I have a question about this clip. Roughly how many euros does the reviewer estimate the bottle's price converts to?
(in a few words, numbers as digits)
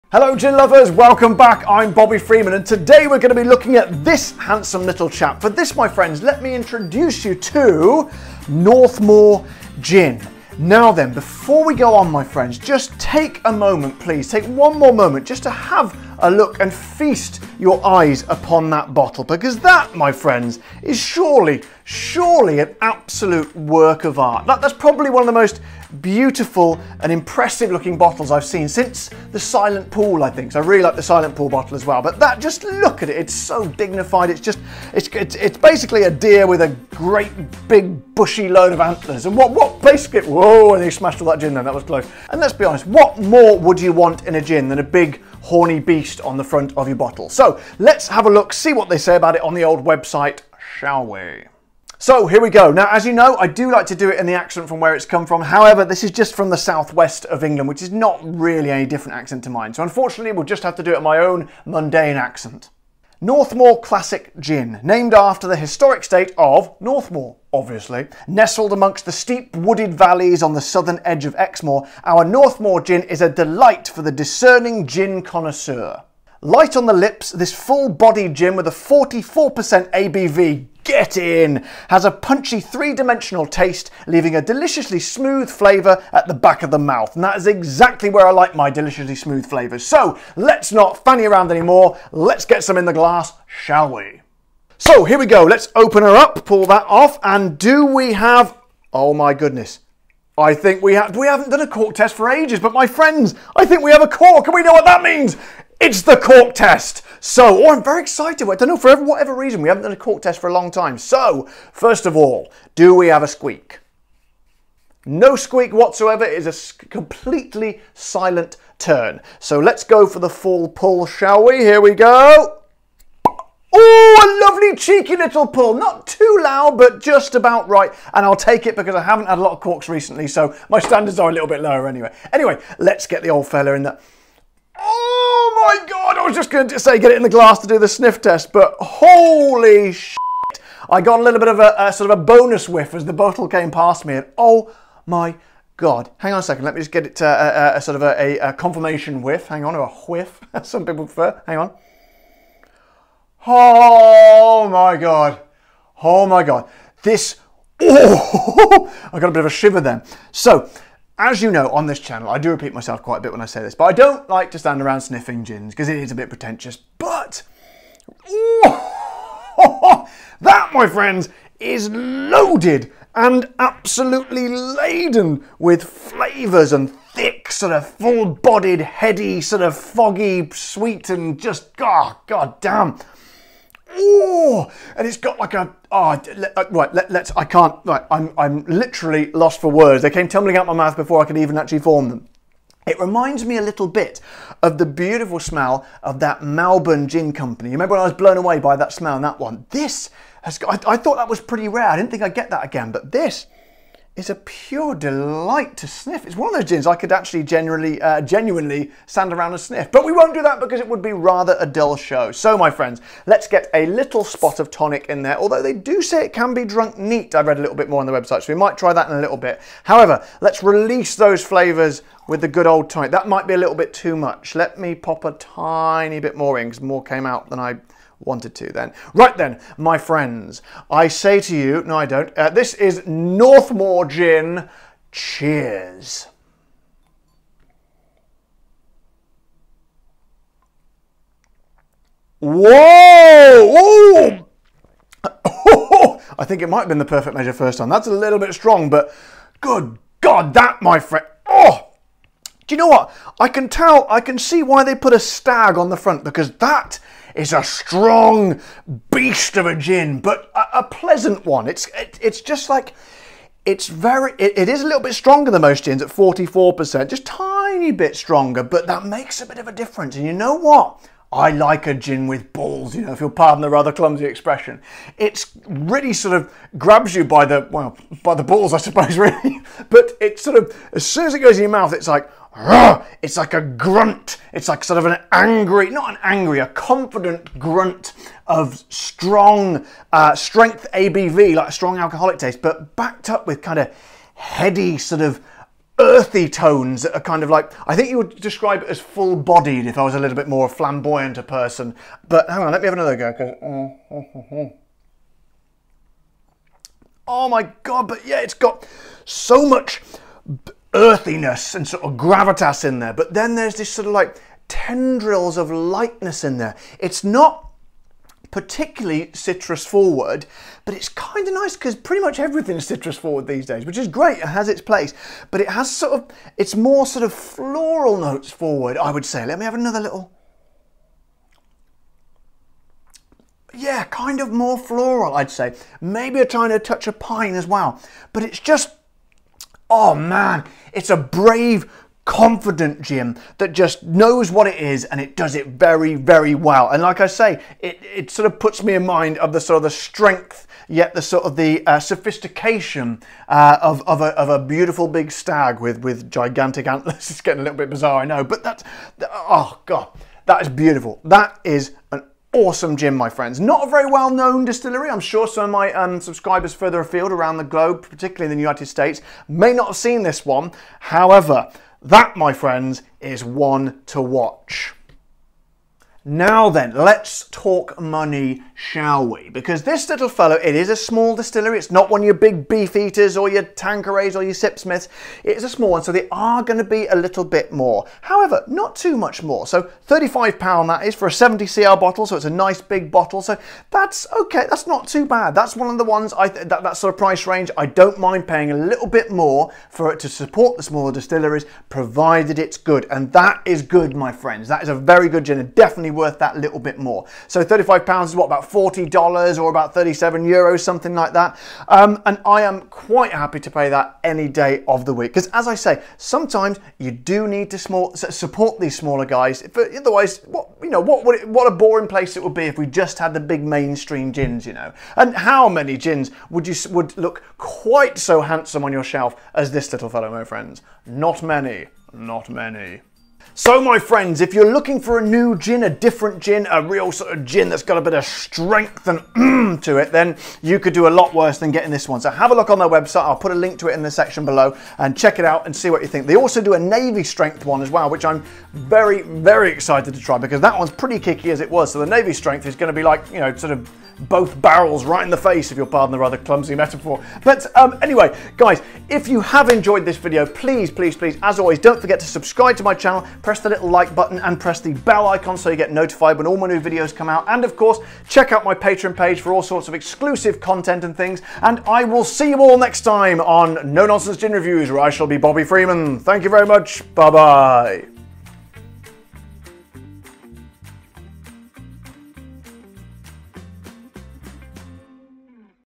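37 euros.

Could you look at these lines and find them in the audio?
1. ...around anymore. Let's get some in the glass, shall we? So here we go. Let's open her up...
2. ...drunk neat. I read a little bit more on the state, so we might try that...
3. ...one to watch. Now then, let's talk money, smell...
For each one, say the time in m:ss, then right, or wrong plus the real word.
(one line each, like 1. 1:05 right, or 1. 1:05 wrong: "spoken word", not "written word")
1. 1:31 right
2. 3:36 wrong: "website", not "state"
3. 6:13 wrong: "shall", not "smell".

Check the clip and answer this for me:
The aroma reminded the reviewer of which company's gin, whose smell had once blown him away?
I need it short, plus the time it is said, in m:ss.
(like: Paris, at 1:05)
Melbourne Gin Company, at 3:16.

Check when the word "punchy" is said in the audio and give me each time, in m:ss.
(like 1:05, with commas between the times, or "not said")
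1:22.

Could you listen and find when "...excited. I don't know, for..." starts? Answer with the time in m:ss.
1:48.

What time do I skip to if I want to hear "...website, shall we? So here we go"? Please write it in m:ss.
0:49.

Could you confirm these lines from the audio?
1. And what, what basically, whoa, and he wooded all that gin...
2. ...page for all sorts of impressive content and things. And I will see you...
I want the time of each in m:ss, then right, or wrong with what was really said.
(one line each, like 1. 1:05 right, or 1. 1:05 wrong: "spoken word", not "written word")
1. 0:39 wrong: "smashed", not "wooded"
2. 7:49 wrong: "exclusive", not "impressive".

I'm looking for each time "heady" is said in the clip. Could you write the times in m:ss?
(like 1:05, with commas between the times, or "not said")
2:58, 4:54.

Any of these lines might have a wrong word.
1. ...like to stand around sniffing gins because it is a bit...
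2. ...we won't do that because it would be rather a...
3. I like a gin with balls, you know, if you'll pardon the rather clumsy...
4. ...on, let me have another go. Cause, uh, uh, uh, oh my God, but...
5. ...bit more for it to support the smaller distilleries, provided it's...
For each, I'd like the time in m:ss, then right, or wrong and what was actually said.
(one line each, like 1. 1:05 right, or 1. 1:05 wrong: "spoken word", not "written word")
1. 2:44 right
2. 3:30 right
3. 4:31 right
4. 5:02 right
5. 6:39 right.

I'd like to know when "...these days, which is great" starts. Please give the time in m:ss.
5:23.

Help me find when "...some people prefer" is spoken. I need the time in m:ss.
2:30.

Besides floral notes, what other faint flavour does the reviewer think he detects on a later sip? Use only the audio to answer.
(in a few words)
pine.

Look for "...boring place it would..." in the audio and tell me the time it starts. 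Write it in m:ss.
7:01.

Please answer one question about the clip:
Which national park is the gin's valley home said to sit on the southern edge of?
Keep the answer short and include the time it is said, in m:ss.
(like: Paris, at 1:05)
Exmoor, at 1:11.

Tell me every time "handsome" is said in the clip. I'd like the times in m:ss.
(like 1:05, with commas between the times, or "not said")
0:04, 7:08.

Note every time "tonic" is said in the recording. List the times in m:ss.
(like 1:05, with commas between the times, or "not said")
3:34, 3:42.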